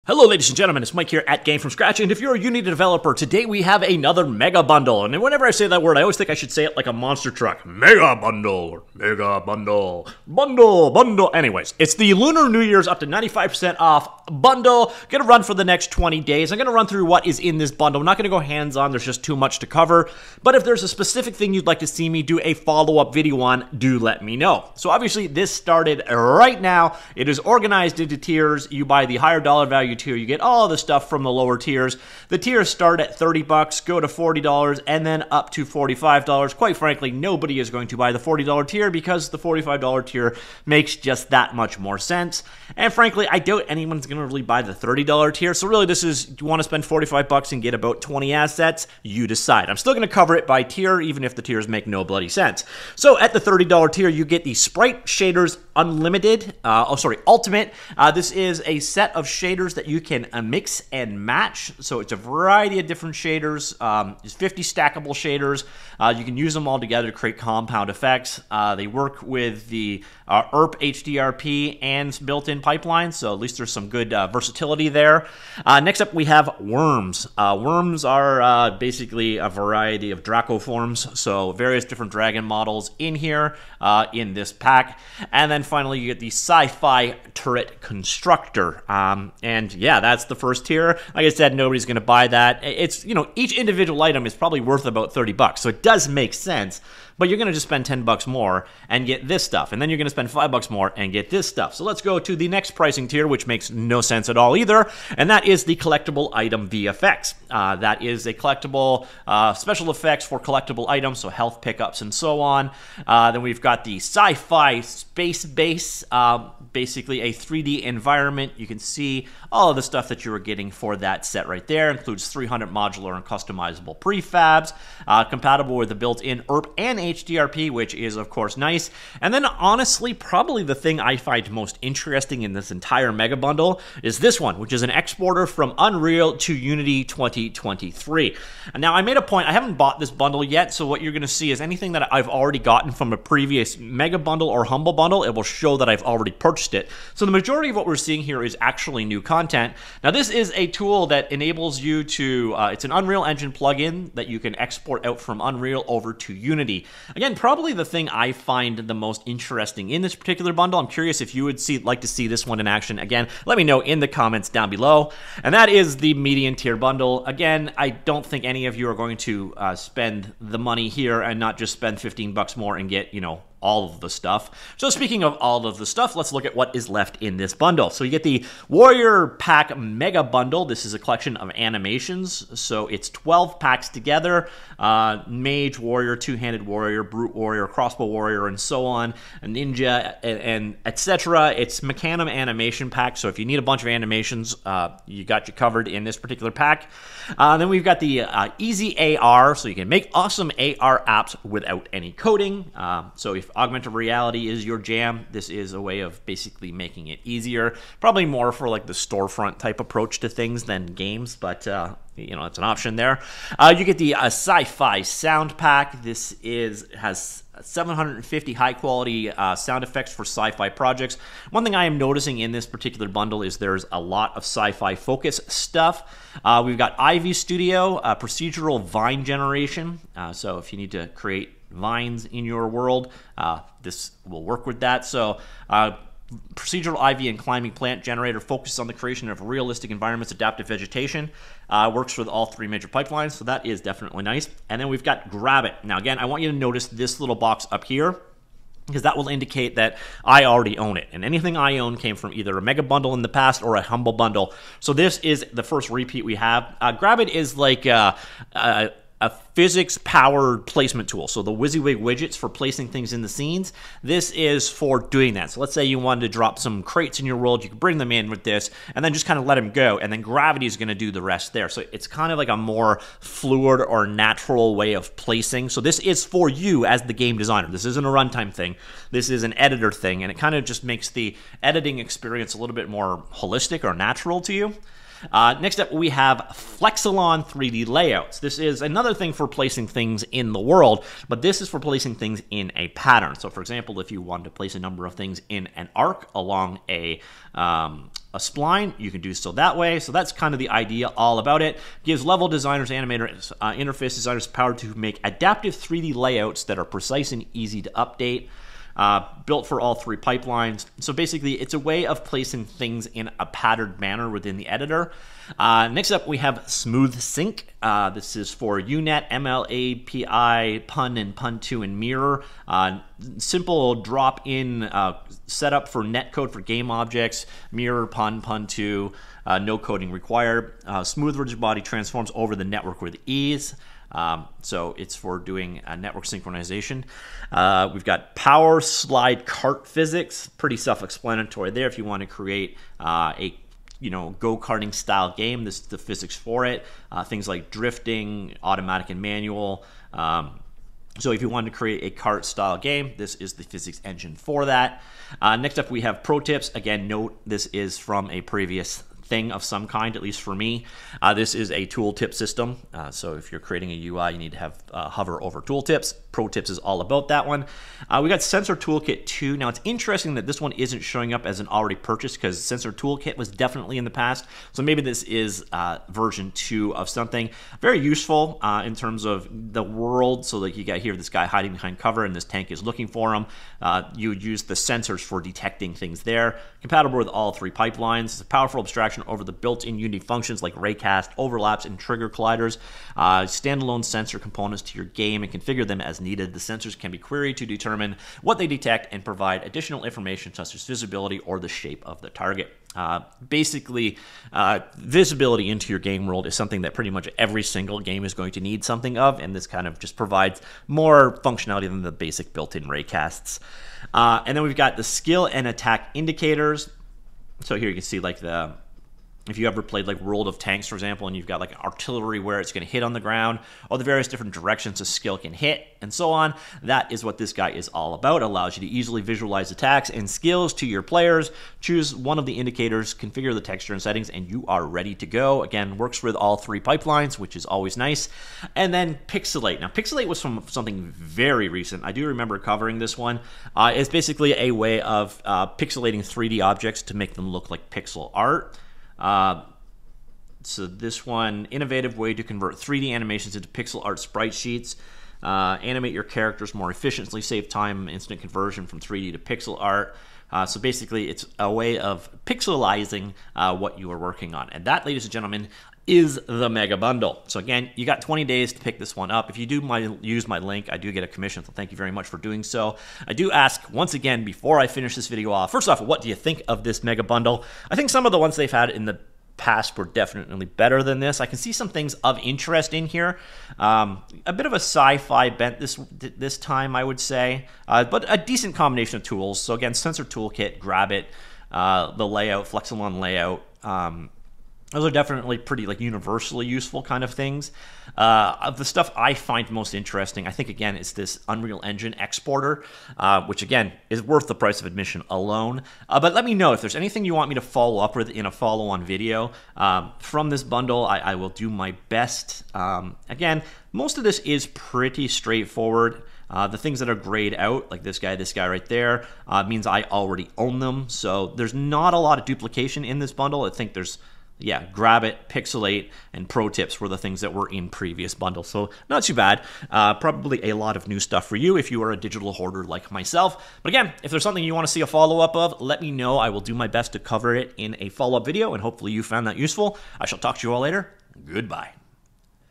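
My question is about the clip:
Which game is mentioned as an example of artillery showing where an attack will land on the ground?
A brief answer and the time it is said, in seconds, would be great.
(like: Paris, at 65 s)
World of Tanks, at 420 s.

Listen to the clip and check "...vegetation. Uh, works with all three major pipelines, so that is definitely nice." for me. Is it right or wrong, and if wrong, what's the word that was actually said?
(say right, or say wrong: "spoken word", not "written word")
right.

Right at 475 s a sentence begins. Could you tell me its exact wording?
First off, what do you think of this mega bundle?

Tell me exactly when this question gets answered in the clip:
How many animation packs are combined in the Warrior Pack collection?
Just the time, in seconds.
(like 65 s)
183 s.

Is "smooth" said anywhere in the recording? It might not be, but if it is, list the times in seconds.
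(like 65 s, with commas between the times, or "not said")
316 s, 331 s.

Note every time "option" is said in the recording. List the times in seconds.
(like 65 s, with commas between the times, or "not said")
212 s.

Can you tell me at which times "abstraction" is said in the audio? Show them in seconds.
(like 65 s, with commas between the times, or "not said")
388 s.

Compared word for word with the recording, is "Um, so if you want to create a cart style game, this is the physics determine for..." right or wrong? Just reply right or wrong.
wrong.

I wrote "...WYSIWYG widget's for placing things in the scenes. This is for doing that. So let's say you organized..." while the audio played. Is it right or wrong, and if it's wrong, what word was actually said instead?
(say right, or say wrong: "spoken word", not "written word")
wrong: "wanted", not "organized".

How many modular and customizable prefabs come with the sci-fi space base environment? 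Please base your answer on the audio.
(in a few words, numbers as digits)
300.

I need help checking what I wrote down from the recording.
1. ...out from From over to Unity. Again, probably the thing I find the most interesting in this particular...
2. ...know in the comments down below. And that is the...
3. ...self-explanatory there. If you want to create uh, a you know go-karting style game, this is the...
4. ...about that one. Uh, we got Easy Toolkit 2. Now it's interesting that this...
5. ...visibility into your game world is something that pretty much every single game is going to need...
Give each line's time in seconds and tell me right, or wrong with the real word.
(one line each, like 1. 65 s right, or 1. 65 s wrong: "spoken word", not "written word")
1. 155 s wrong: "Unreal", not "From"
2. 163 s right
3. 340 s right
4. 367 s wrong: "Sensor", not "Easy"
5. 404 s right.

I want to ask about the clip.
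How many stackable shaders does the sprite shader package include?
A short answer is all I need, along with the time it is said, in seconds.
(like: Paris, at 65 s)
50, at 64 s.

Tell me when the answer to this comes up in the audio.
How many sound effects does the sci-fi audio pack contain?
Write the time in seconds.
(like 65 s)
217 s.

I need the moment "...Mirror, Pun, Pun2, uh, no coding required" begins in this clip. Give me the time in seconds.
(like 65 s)
327 s.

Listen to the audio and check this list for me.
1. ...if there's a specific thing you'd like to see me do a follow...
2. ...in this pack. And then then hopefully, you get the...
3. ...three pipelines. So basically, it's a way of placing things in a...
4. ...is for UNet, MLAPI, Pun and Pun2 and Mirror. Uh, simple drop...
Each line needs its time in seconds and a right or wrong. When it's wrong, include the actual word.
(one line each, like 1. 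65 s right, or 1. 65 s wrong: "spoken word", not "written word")
1. 20 s right
2. 84 s wrong: "finally", not "hopefully"
3. 309 s right
4. 318 s right.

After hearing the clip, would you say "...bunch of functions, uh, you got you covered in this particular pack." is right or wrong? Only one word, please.
wrong.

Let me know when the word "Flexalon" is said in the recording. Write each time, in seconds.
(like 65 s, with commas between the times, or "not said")
286 s, 492 s.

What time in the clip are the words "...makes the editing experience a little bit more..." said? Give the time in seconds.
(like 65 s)
280 s.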